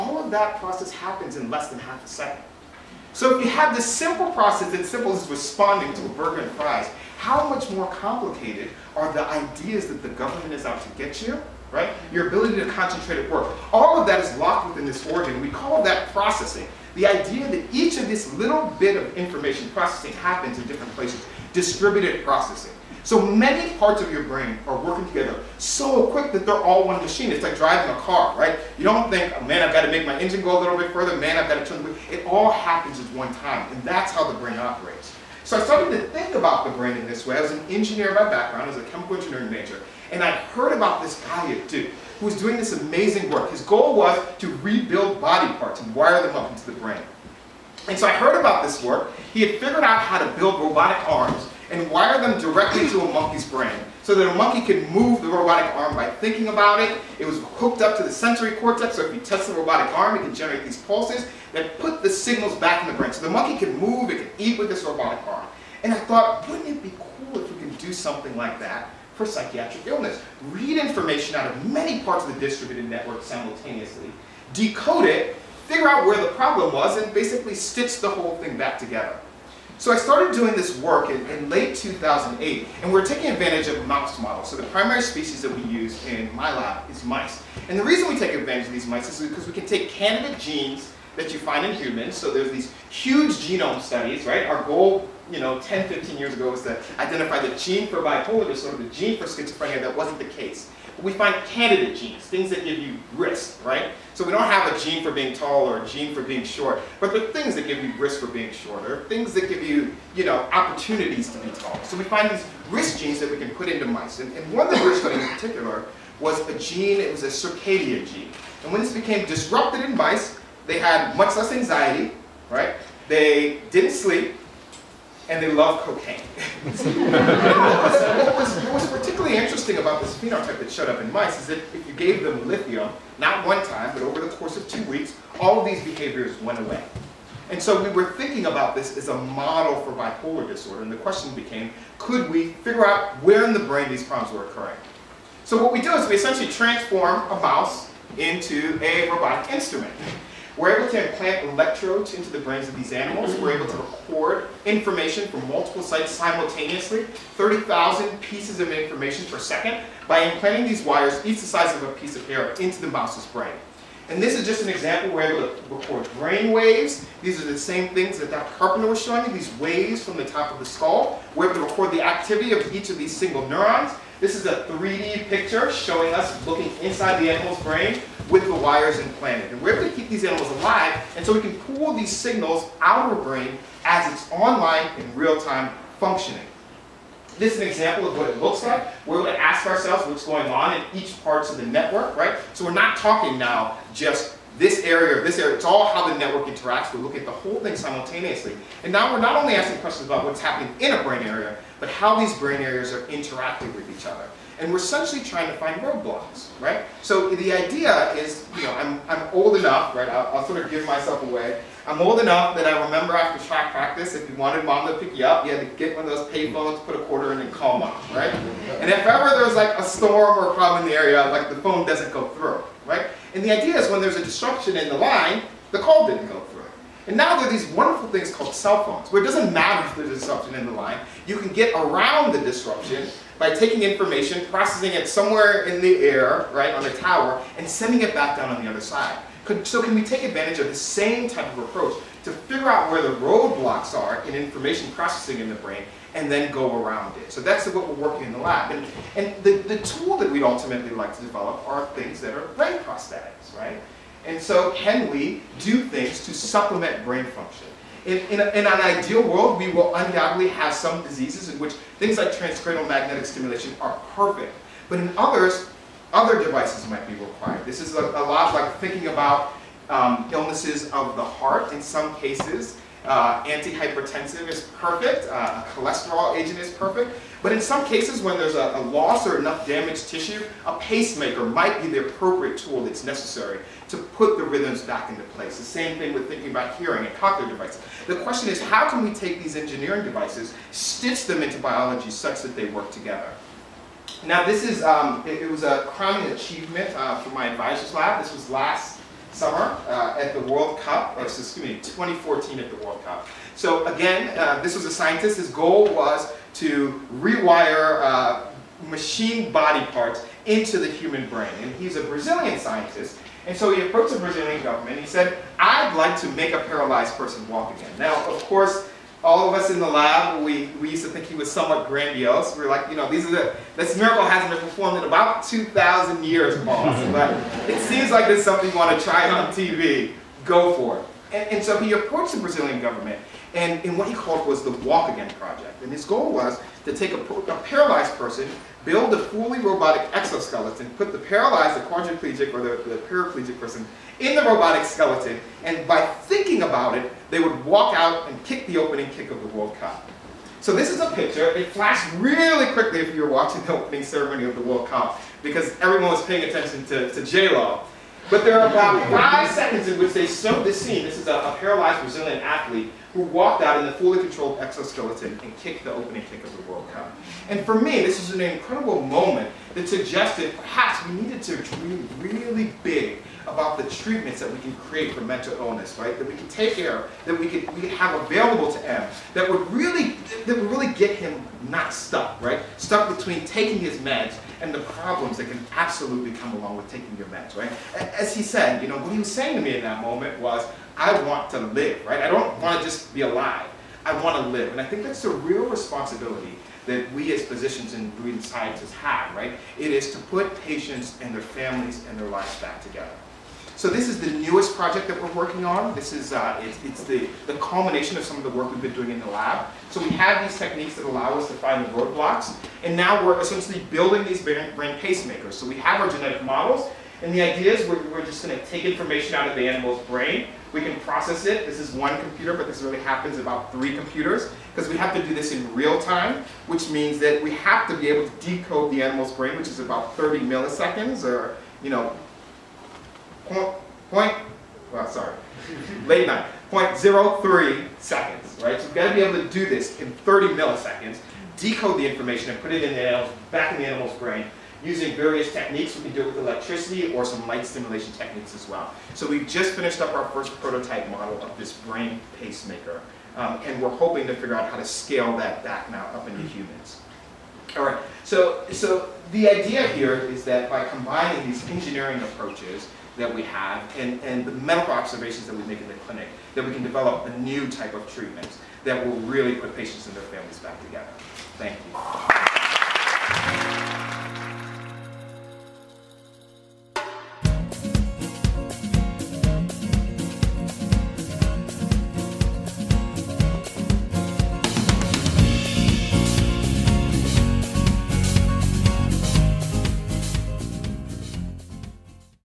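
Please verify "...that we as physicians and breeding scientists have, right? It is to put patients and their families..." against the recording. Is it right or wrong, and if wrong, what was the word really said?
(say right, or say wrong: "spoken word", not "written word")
right.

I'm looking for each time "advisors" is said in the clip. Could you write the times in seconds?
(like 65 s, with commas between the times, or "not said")
297 s.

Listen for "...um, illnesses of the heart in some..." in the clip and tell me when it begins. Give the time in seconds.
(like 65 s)
269 s.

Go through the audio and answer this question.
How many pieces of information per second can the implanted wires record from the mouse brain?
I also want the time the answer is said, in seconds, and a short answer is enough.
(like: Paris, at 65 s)
30,000, at 157 s.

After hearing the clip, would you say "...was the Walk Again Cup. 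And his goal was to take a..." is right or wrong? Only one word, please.
wrong.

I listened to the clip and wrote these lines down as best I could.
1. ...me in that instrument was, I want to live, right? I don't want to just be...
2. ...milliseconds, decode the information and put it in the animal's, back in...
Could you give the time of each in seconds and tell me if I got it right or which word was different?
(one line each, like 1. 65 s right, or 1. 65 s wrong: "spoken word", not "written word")
1. 389 s wrong: "moment", not "instrument"
2. 440 s right.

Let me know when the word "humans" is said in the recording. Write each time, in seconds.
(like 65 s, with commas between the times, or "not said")
91 s, 310 s, 456 s.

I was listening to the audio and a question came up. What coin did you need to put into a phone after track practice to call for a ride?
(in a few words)
a quarter.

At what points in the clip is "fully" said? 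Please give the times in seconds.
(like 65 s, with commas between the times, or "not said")
339 s, 363 s.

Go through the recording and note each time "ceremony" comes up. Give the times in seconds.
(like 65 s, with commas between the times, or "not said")
354 s.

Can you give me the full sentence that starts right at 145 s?
So what we do is we essentially transform a mouse into a robotic instrument.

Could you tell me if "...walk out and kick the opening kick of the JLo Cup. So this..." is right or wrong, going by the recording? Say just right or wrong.
wrong.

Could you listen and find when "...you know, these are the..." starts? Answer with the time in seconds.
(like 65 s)
322 s.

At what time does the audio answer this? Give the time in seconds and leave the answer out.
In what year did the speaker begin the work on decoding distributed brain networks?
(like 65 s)
81 s.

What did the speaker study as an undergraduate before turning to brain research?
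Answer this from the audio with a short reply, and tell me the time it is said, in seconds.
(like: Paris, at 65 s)
chemical engineering, at 38 s.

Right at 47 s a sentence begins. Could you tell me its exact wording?
And so I heard about this work.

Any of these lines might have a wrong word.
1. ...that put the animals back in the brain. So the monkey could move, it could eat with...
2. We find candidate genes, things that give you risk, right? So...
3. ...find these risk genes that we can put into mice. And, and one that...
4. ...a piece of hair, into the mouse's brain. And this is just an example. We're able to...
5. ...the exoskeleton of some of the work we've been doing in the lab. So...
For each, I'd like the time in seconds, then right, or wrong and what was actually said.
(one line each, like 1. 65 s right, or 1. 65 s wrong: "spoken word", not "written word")
1. 61 s wrong: "signals", not "animals"
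2. 101 s right
3. 112 s right
4. 161 s right
5. 407 s wrong: "culmination", not "exoskeleton".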